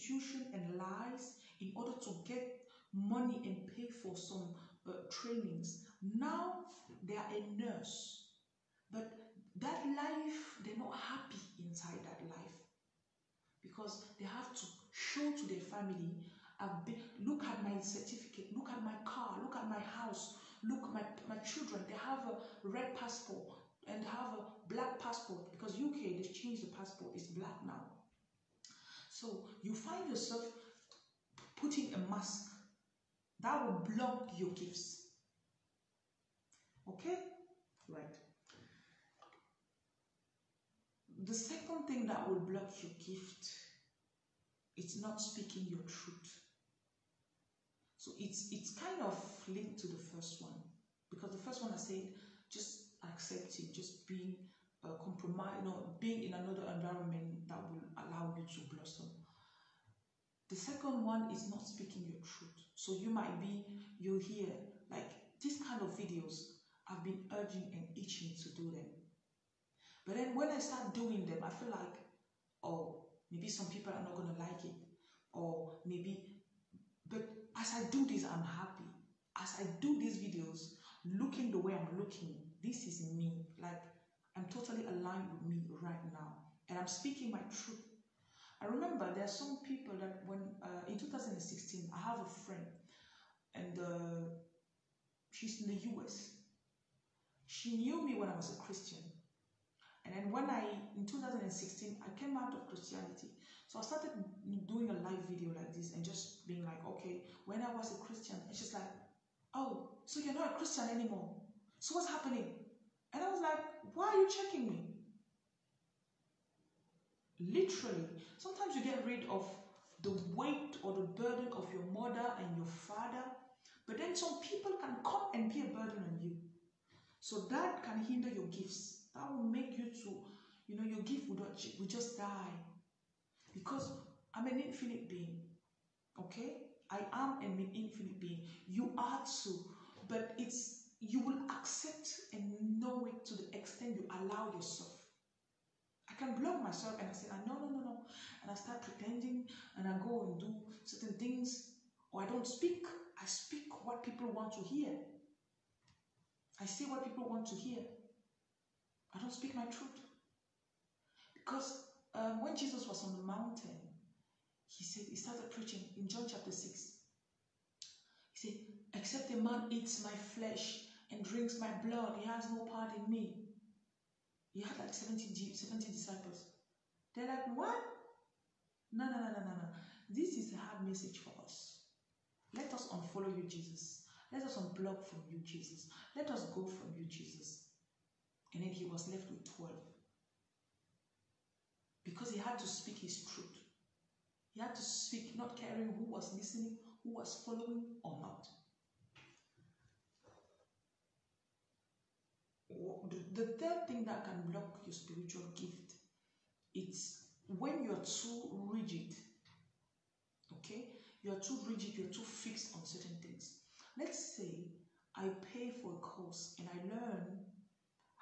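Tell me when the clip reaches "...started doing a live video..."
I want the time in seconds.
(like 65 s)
103 s.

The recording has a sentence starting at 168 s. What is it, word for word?
He said, Except a man eats my flesh and drinks my blood, he has no part in me.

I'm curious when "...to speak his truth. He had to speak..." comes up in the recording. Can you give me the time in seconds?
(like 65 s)
192 s.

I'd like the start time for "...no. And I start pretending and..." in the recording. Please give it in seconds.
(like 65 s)
147 s.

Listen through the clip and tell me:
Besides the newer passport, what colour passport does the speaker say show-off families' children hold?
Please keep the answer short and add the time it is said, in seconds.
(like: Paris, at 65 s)
red, at 22 s.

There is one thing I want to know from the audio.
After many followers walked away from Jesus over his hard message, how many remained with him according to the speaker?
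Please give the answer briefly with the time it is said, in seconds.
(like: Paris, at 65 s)
12, at 189 s.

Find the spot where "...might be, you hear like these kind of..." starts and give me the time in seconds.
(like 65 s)
63 s.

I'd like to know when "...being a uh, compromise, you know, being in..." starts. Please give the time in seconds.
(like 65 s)
54 s.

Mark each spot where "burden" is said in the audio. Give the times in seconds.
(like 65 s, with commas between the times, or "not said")
121 s, 125 s.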